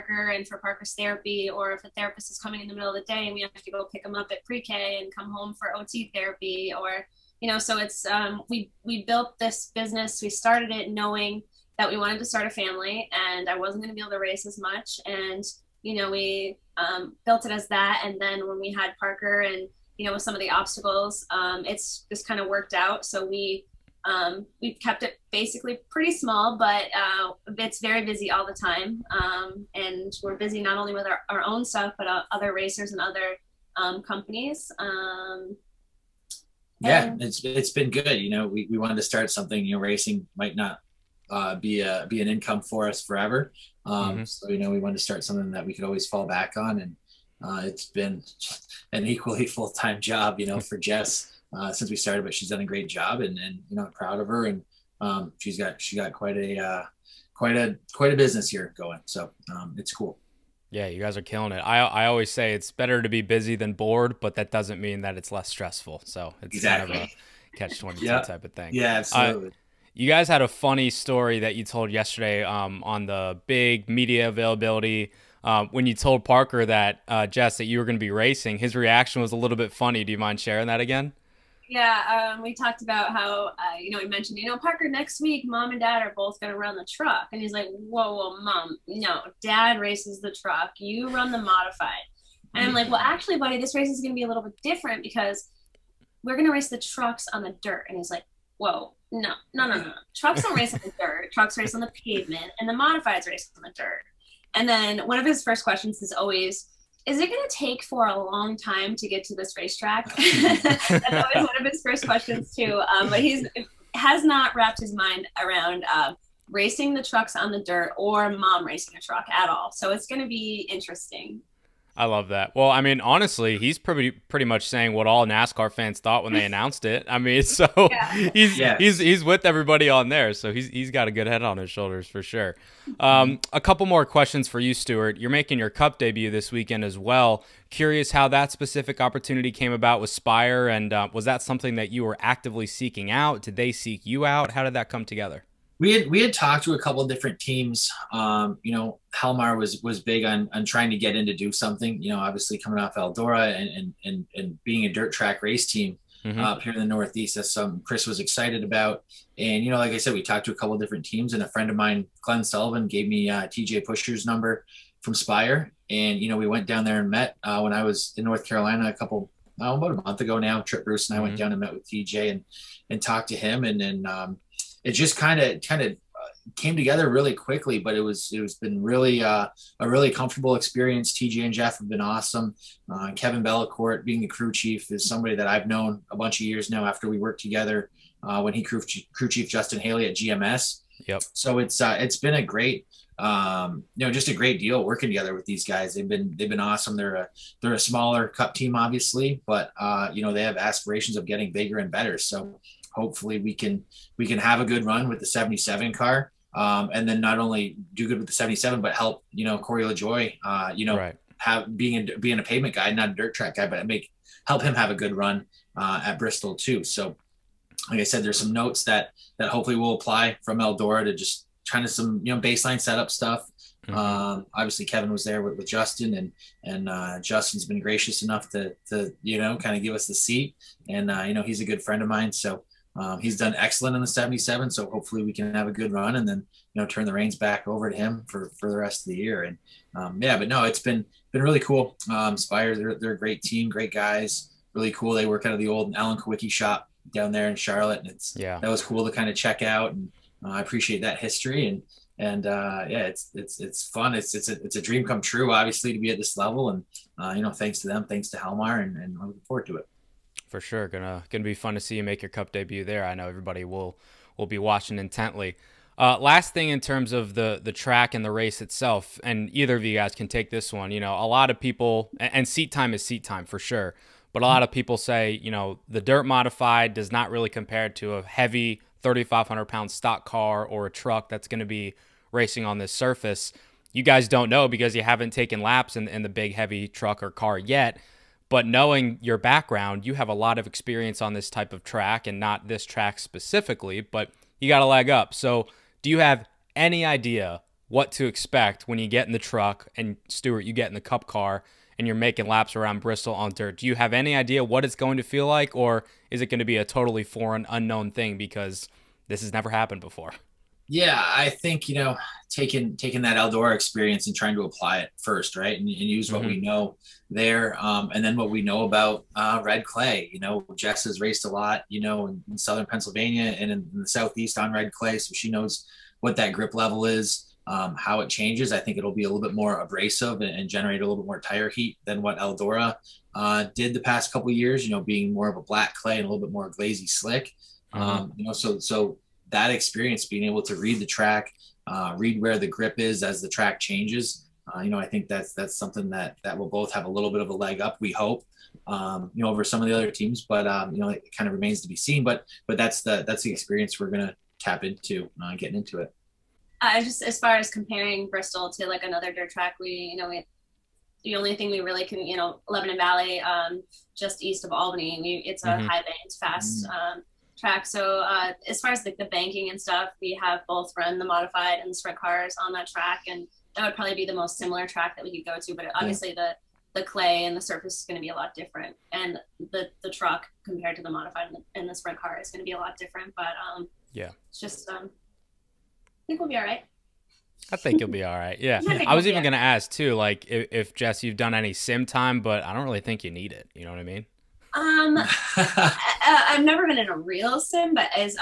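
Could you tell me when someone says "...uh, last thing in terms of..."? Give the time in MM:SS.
04:25.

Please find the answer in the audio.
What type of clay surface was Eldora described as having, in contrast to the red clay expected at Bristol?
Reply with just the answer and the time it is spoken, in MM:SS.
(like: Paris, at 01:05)
black clay, at 05:35.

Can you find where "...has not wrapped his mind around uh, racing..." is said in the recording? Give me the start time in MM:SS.
01:53.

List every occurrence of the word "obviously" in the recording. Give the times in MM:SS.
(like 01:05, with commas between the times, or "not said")
02:32, 03:18, 03:44, 04:15, 06:15.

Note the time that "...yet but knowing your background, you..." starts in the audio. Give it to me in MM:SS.
04:47.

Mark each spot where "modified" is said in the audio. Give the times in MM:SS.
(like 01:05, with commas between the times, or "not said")
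01:31, 01:42, 04:36, 06:11, 06:21.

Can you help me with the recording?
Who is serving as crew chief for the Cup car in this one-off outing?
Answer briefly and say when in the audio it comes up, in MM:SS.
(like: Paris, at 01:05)
Kevin Bellicourt, at 03:03.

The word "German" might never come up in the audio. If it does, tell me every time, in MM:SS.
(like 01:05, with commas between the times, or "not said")
not said.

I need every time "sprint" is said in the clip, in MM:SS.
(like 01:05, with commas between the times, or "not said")
06:11, 06:21.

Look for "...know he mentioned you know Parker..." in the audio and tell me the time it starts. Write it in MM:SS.
01:23.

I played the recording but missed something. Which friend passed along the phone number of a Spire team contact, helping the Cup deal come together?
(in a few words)
Glenn Sullivan.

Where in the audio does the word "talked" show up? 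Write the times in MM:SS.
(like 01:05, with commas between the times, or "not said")
01:22, 02:26, 02:40, 02:53.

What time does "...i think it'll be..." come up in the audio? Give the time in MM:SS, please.
05:28.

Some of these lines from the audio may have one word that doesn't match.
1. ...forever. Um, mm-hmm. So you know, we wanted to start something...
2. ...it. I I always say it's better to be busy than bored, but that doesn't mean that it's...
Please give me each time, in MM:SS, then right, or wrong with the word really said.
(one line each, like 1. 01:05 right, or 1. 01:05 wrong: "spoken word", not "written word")
1. 00:43 right
2. 01:01 right.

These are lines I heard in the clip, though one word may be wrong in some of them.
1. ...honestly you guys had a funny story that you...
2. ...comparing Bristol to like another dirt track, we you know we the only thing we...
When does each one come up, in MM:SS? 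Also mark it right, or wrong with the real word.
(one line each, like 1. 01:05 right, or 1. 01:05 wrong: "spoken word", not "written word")
1. 01:08 wrong: "absolutely", not "honestly"
2. 05:57 right.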